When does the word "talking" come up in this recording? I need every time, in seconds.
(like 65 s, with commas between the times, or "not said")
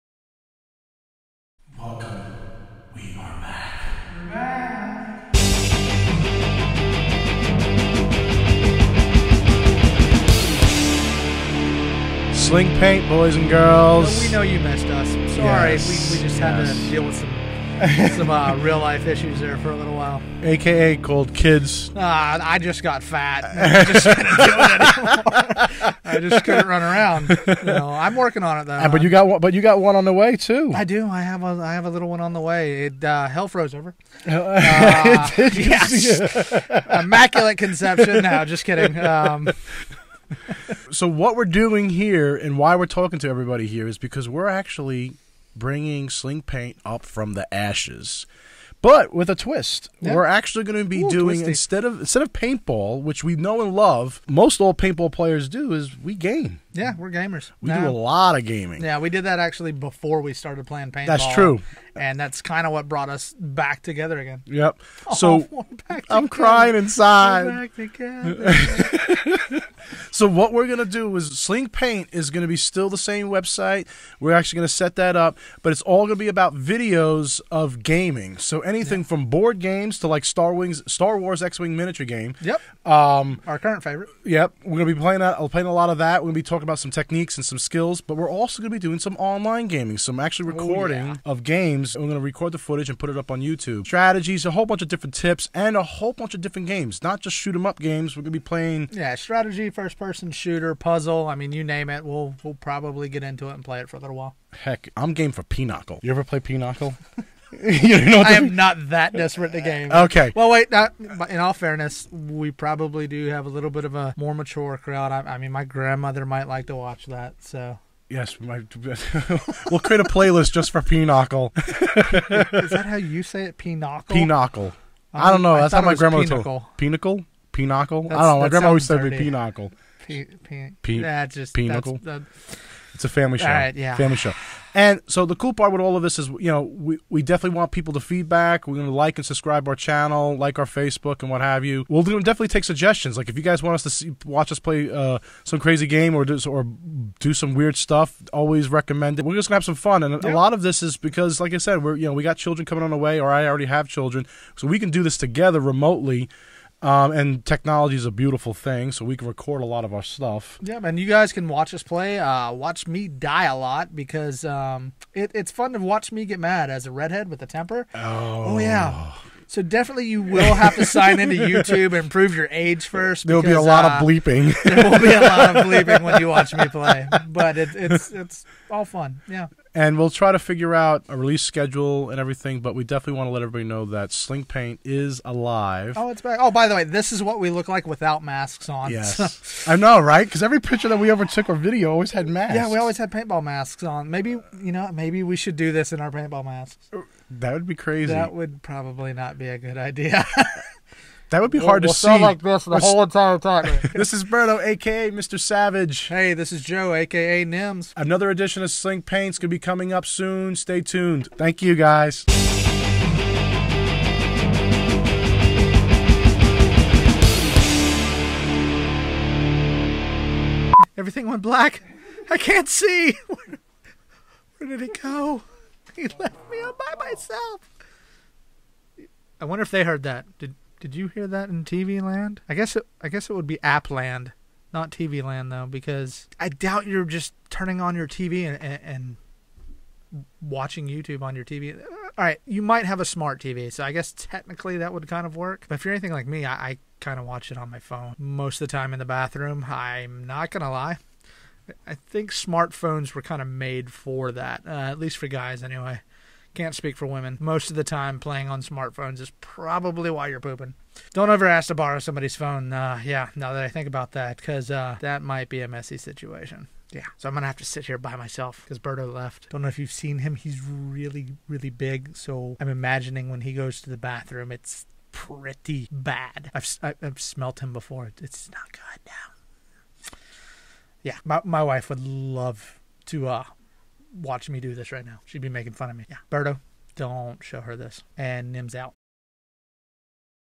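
42 s, 86 s.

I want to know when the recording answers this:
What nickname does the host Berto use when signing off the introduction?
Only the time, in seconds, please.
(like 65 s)
205 s.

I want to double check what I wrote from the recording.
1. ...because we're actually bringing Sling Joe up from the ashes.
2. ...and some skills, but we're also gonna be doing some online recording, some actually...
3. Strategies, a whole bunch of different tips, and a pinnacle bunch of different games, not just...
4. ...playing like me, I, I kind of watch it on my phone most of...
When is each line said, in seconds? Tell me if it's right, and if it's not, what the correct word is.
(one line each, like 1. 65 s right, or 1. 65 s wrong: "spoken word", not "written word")
1. 43 s wrong: "Paint", not "Joe"
2. 87 s wrong: "gaming", not "recording"
3. 93 s wrong: "whole", not "pinnacle"
4. 245 s wrong: "anything", not "playing".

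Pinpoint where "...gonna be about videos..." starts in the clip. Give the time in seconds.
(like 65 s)
76 s.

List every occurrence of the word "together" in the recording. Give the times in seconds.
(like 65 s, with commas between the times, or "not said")
63 s, 155 s.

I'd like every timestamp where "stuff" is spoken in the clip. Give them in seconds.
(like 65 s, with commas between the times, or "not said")
147 s, 160 s.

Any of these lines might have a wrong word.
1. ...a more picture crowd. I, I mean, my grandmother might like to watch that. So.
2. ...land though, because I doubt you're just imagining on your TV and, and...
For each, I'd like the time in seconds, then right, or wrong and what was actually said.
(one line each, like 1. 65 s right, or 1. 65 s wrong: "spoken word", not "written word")
1. 113 s wrong: "mature", not "picture"
2. 235 s wrong: "turning", not "imagining".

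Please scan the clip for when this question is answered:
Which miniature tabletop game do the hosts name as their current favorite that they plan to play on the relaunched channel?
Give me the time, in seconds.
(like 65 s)
80 s.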